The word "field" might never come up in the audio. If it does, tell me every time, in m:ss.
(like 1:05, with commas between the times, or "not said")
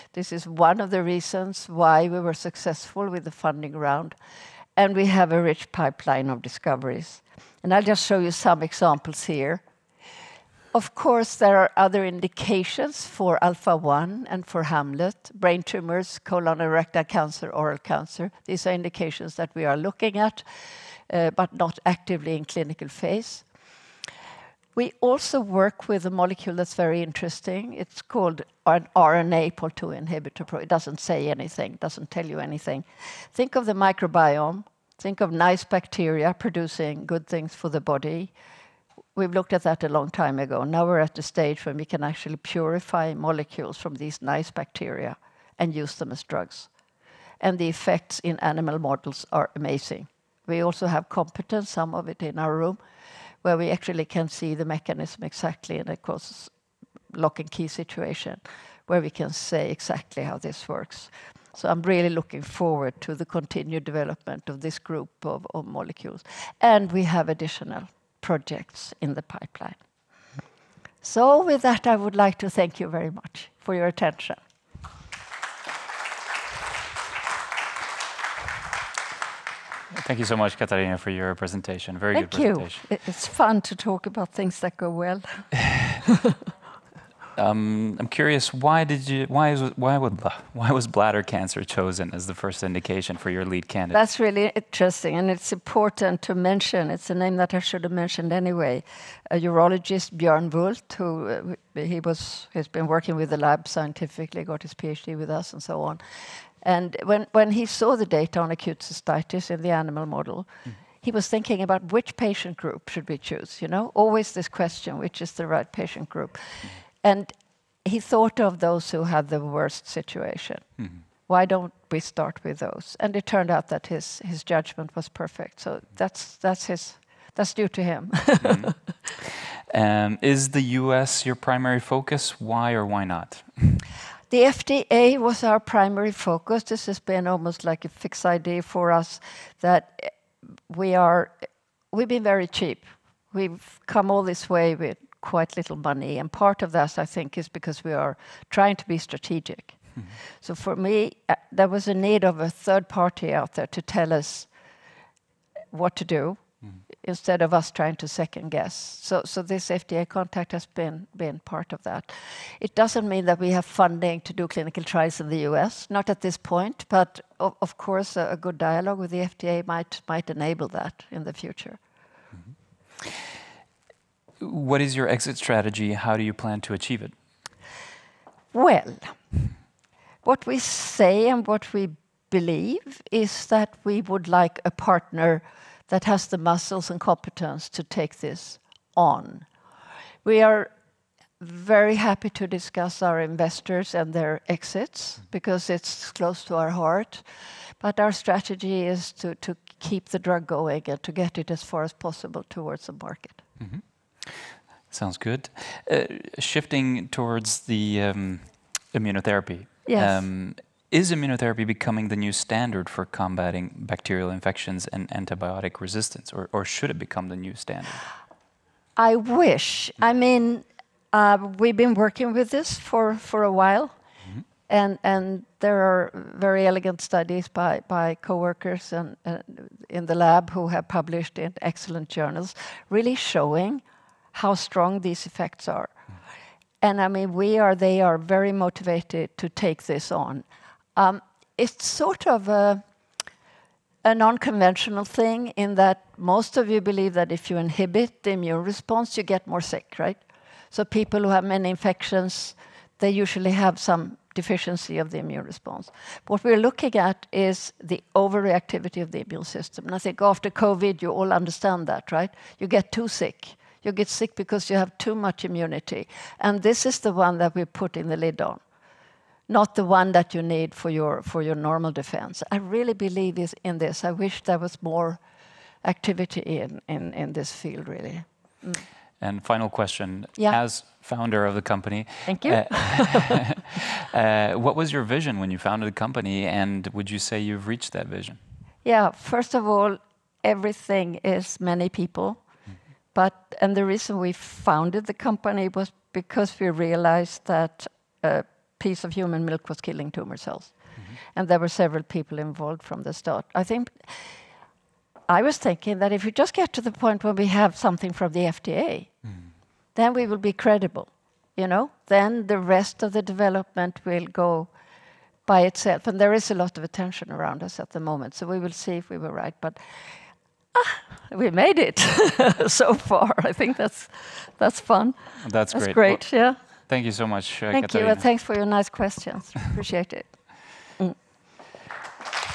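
4:37.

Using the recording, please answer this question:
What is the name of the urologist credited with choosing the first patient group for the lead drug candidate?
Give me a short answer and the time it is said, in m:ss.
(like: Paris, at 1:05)
Björn Wullt, at 1:40.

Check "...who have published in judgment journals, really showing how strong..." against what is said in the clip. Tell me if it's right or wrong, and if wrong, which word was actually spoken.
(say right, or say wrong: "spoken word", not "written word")
wrong: "excellent", not "judgment".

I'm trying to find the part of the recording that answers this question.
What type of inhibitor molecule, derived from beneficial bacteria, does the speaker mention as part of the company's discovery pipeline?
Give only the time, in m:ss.
0:28.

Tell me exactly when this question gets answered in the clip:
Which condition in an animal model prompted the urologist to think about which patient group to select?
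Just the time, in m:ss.
1:48.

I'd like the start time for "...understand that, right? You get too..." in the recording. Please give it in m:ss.
4:21.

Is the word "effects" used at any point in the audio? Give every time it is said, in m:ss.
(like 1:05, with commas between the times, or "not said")
0:47, 3:55.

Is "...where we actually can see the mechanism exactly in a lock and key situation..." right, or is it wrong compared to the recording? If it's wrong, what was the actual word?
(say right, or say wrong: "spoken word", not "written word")
right.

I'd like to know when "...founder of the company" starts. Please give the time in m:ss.
4:41.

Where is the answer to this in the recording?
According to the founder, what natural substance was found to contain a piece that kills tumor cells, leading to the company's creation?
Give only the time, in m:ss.
4:59.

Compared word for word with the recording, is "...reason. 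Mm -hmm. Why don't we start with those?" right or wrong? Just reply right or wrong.
wrong.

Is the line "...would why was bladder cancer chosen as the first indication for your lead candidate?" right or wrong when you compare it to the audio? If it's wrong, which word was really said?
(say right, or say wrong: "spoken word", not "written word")
right.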